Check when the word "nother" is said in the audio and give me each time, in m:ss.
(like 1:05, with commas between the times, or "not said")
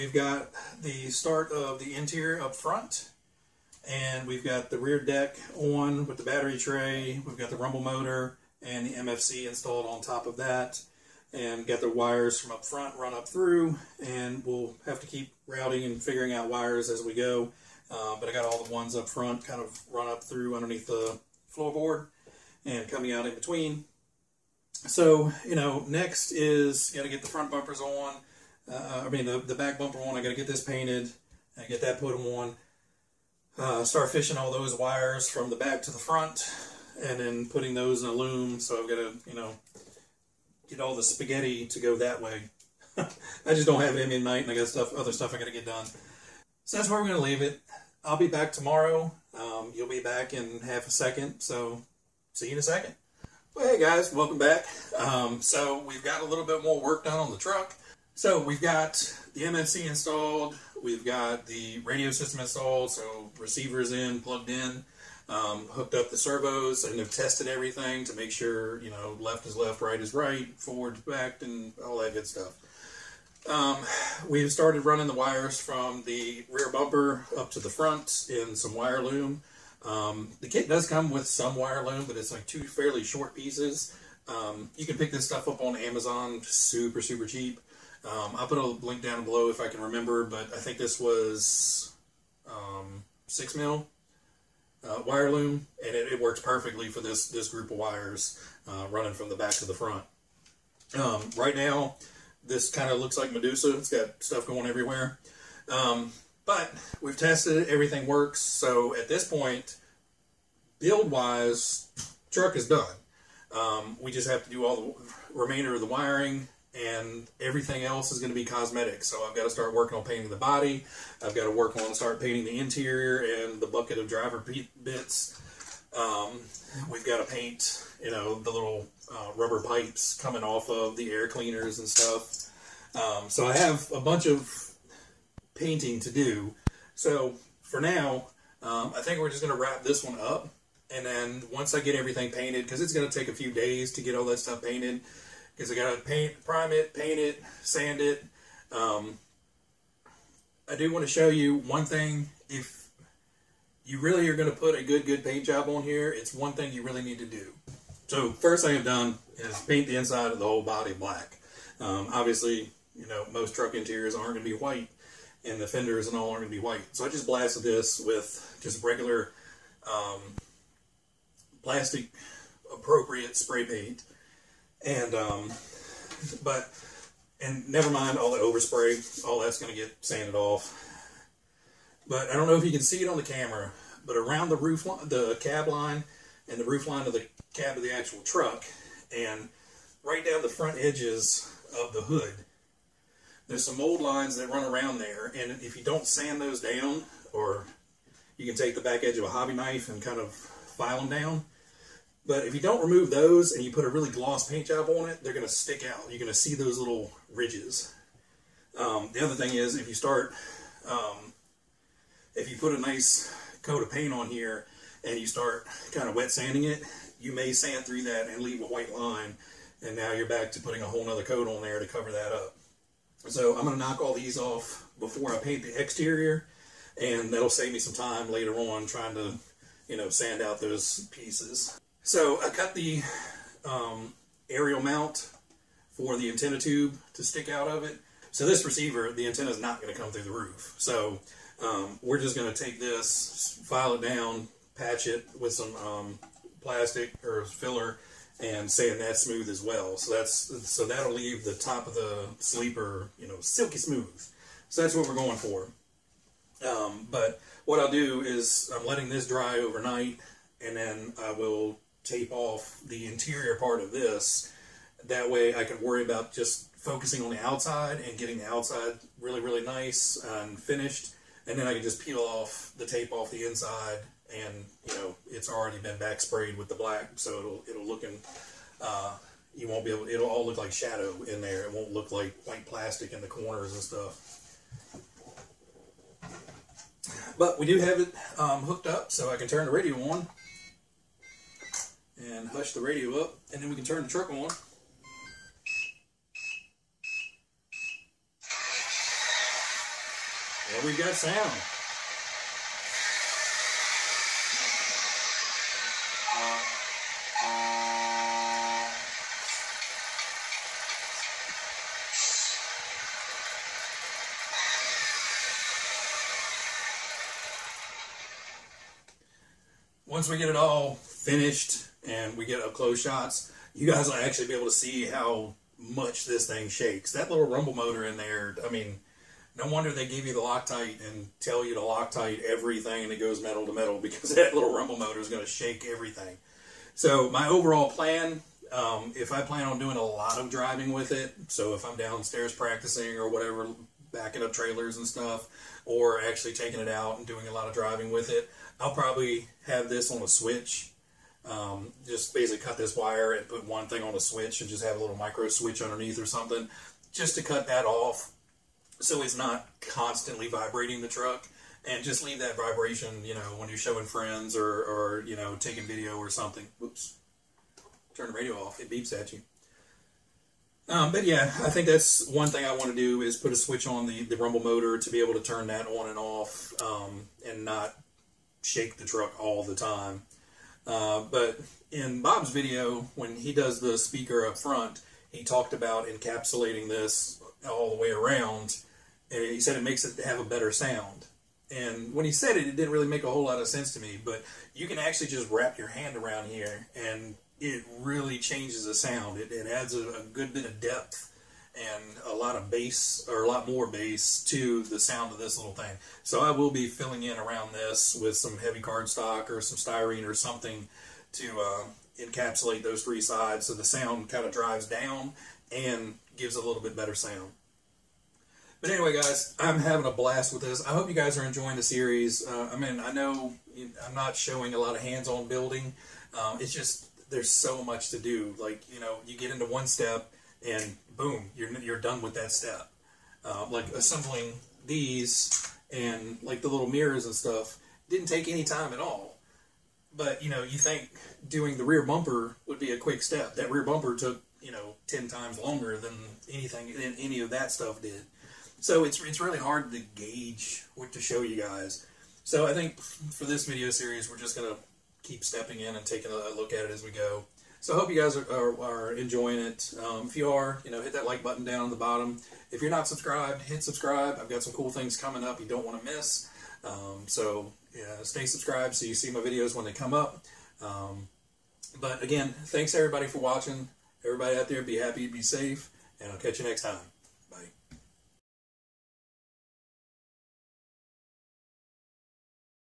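3:41.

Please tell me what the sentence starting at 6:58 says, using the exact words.
But anyway, guys, I'm having a blast with this.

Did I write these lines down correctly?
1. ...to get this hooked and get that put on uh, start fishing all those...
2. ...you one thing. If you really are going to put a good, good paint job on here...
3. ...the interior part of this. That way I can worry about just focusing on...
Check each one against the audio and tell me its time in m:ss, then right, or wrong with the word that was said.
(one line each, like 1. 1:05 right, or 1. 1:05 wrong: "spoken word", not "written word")
1. 0:30 wrong: "painted", not "hooked"
2. 2:31 right
3. 4:22 right.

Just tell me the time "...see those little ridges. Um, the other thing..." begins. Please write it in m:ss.
3:26.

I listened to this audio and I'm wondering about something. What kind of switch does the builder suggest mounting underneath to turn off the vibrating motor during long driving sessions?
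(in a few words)
Micro switch.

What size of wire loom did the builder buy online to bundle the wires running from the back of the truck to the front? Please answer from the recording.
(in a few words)
6 mil.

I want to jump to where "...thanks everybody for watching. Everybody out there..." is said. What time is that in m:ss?
7:52.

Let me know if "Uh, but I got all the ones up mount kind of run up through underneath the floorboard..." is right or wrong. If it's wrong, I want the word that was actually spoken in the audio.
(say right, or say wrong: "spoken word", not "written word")
wrong: "front", not "mount".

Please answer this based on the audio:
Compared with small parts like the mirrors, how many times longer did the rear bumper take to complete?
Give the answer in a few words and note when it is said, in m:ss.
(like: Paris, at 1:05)
10, at 7:25.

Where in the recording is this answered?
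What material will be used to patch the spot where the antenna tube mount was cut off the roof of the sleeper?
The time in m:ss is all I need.
4:06.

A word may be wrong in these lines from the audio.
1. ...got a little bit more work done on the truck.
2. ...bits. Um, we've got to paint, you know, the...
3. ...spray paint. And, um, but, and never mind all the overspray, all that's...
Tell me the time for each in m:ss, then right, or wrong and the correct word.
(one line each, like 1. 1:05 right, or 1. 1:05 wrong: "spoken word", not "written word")
1. 0:56 right
2. 2:04 right
3. 2:53 right.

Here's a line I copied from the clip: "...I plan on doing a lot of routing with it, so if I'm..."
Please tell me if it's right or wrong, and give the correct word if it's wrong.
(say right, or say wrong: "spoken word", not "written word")
wrong: "driving", not "routing".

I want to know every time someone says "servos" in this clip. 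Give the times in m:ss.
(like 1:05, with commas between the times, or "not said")
1:06.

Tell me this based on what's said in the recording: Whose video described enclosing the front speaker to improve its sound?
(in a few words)
Bob.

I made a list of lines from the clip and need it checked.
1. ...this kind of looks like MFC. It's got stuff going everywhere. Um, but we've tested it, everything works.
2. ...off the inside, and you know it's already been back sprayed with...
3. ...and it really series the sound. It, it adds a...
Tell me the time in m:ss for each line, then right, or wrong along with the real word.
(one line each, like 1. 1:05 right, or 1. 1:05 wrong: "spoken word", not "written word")
1. 1:42 wrong: "Medusa", not "MFC"
2. 4:33 right
3. 6:36 wrong: "changes", not "series".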